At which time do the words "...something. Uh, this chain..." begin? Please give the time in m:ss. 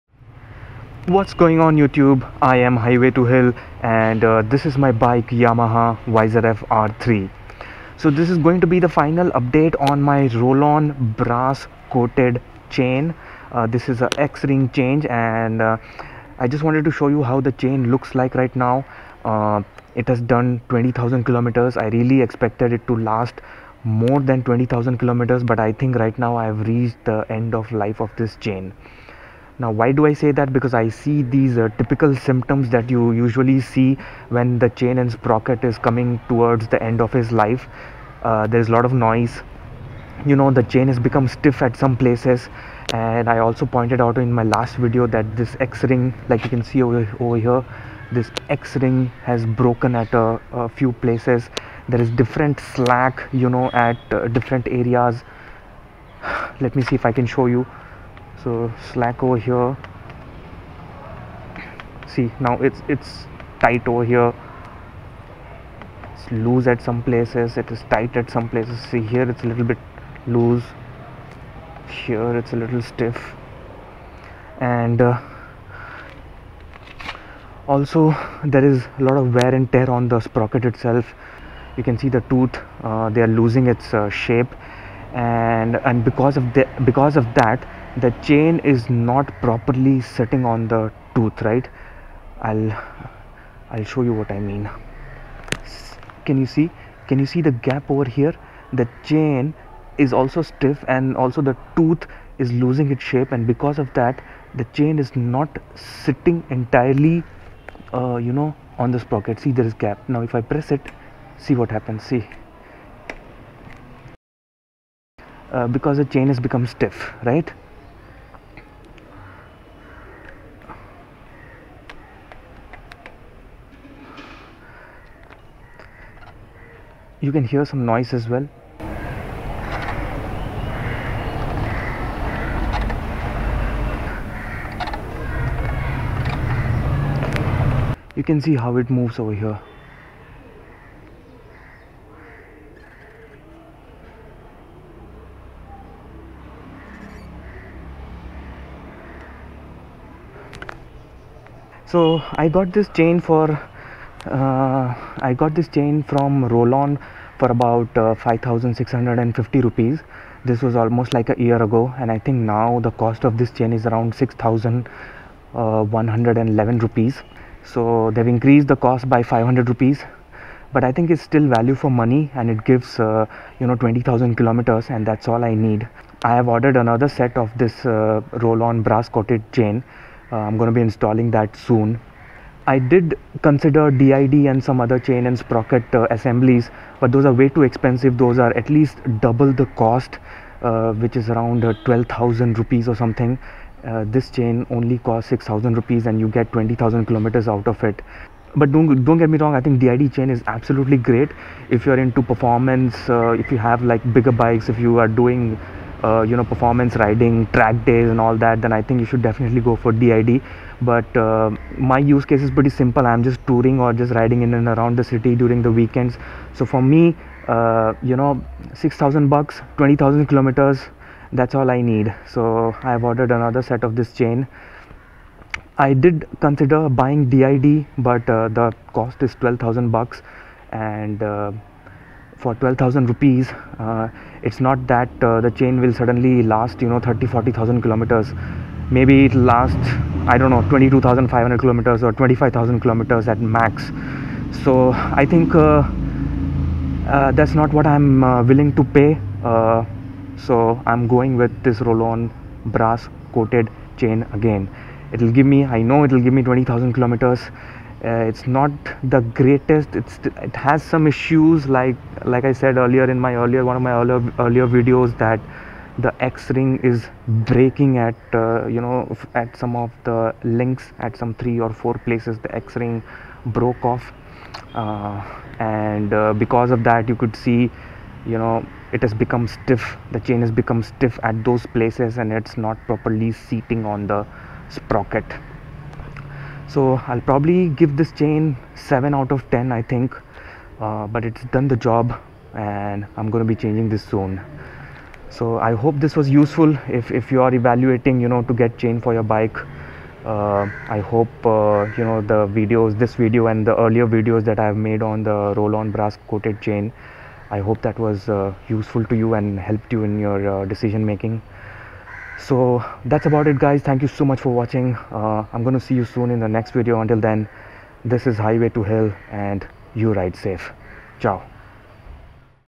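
3:12.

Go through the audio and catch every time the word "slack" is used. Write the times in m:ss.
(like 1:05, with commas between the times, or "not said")
0:52, 0:58.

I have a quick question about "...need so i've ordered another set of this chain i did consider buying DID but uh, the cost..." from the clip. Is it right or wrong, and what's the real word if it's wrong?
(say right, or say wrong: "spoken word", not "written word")
right.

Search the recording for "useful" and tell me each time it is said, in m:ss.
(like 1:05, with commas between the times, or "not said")
4:56, 5:08.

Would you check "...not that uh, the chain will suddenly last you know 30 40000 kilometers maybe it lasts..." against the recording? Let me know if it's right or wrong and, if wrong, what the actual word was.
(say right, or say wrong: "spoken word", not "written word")
right.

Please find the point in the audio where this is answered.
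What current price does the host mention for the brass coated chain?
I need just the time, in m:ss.
2:44.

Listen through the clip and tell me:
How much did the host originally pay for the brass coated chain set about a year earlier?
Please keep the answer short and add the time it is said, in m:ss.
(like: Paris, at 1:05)
5650 rupees, at 2:38.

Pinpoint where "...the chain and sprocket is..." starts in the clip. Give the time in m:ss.
0:34.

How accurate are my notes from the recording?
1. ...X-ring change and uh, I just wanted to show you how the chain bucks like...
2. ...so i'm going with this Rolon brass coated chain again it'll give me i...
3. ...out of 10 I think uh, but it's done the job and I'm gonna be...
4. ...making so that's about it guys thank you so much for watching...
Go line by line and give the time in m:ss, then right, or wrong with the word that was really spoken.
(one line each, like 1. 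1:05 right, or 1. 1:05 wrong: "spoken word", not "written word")
1. 0:14 wrong: "looks", not "bucks"
2. 4:10 right
3. 4:49 right
4. 5:11 right.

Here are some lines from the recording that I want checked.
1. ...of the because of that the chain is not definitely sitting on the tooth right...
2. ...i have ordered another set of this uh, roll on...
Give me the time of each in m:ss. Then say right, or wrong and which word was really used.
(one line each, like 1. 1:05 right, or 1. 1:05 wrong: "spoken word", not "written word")
1. 1:26 wrong: "properly", not "definitely"
2. 2:56 right.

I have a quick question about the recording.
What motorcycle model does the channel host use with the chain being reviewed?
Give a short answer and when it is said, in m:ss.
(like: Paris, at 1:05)
Yamaha YZF R3, at 0:05.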